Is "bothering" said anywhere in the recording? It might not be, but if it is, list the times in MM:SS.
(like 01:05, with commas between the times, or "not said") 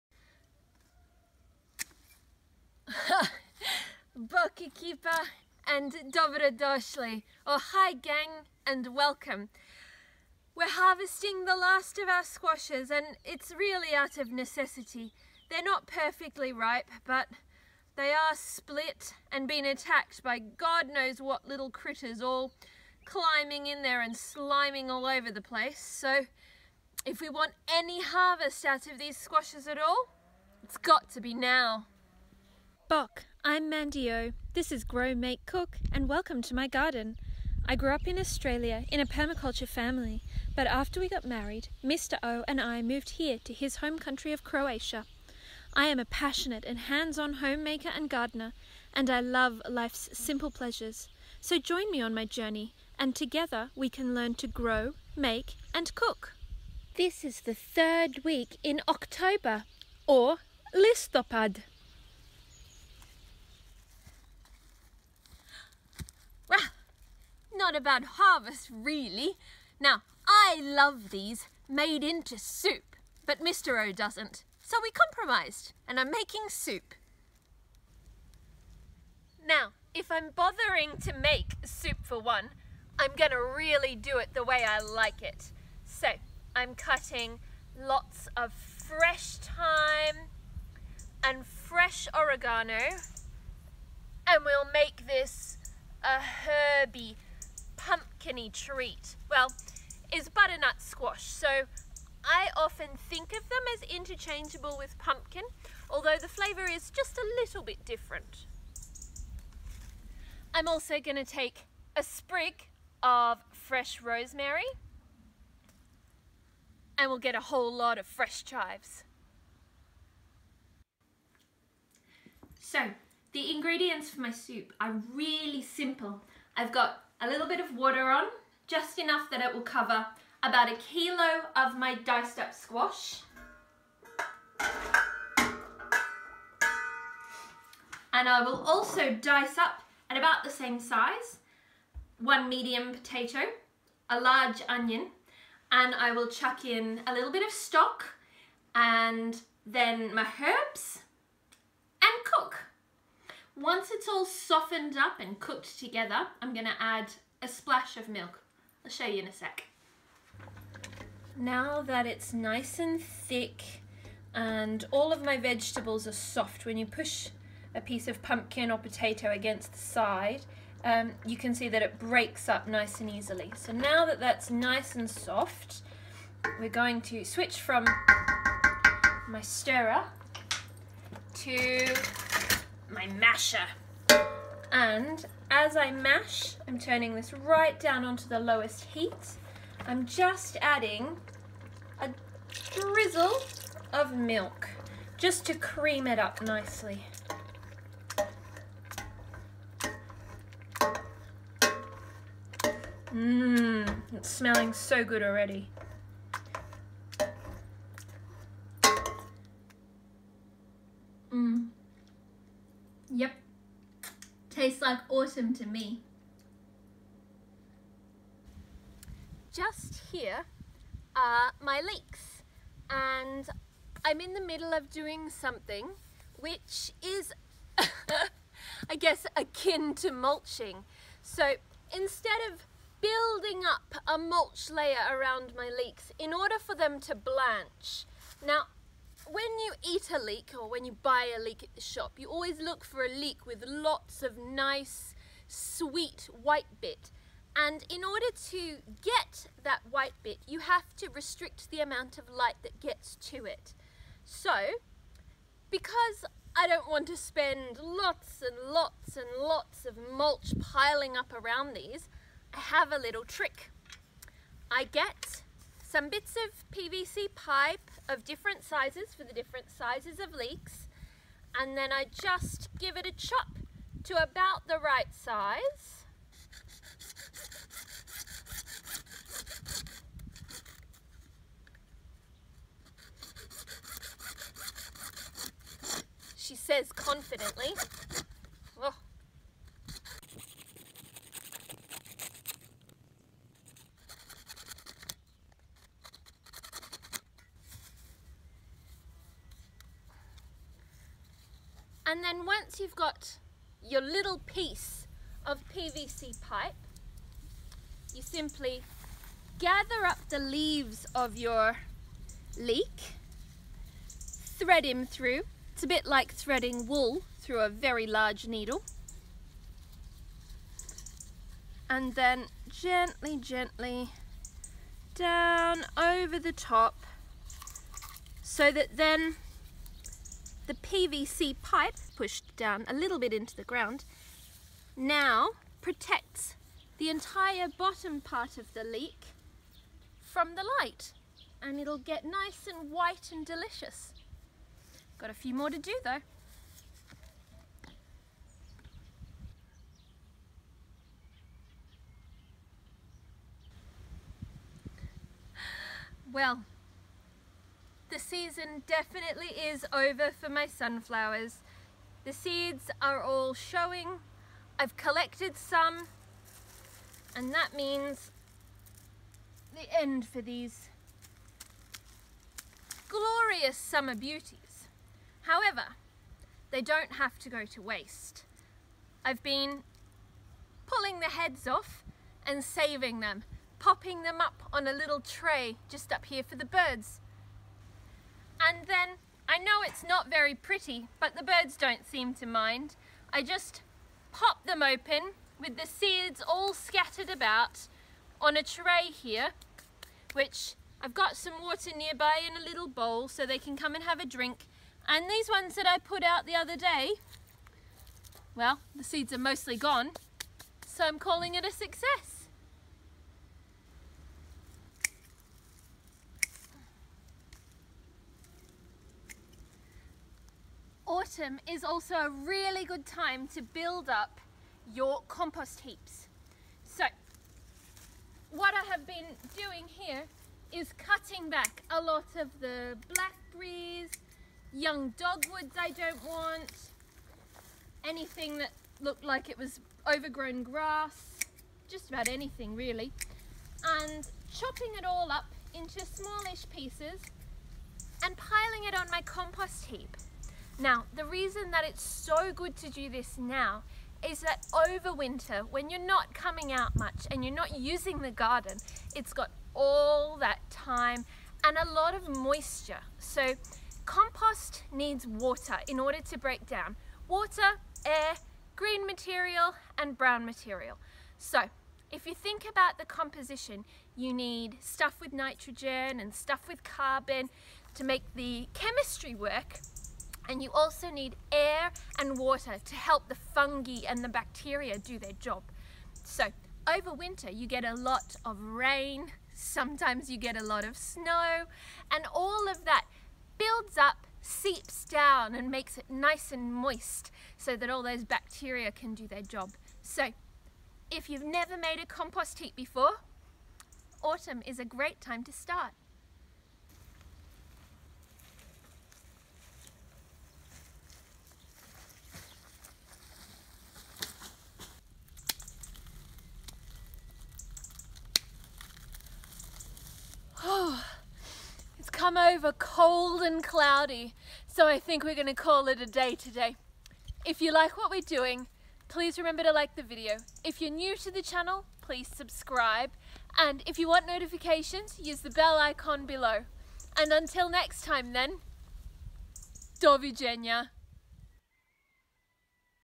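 01:20.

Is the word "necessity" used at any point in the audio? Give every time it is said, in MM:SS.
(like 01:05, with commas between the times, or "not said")
00:14.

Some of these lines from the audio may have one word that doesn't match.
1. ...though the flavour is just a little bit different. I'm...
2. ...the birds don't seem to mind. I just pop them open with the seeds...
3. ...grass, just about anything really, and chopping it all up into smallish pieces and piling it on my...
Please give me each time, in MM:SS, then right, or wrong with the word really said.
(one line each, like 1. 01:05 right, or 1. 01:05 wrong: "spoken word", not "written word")
1. 01:45 wrong: "although", not "though"
2. 06:31 right
3. 07:20 right.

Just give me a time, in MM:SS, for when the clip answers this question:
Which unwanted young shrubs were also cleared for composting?
07:15.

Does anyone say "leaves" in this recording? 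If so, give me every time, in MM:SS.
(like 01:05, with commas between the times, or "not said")
05:10.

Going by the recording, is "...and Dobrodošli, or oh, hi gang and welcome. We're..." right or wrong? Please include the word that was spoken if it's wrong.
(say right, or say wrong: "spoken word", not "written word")
right.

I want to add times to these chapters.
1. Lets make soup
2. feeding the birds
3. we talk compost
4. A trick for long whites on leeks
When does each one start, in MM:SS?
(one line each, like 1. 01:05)
1. 01:10
2. 05:53
3. 06:54
4. 03:38.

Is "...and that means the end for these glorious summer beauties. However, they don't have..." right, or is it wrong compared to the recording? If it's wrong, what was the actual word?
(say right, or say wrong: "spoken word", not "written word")
right.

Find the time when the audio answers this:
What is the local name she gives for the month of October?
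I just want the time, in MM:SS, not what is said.
01:00.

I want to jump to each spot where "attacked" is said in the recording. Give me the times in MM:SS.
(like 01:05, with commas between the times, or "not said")
00:19.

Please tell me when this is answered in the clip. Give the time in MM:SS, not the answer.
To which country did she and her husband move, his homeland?
00:44.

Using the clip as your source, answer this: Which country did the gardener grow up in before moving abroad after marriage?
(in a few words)
Australia.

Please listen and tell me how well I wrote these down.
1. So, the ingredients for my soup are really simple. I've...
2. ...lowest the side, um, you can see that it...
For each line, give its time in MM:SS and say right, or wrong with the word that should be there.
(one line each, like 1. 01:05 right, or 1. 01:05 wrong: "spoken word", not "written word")
1. 02:02 right
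2. 02:49 wrong: "against", not "lowest".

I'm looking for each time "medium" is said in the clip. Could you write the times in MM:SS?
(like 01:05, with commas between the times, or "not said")
02:22.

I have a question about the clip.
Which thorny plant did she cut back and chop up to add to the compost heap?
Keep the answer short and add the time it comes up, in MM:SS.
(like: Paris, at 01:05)
blackberries, at 07:13.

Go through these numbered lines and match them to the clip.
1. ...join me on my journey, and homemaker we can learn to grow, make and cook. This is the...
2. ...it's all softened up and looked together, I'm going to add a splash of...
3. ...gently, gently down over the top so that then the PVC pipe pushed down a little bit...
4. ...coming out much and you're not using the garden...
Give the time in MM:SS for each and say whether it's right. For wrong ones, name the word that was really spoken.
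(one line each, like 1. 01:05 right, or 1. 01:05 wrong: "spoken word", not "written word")
1. 00:51 wrong: "together", not "homemaker"
2. 02:33 wrong: "cooked", not "looked"
3. 05:22 right
4. 07:36 right.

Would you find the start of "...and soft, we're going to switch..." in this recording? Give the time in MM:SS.
02:54.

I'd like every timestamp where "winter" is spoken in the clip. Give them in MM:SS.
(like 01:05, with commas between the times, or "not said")
07:35, 08:07.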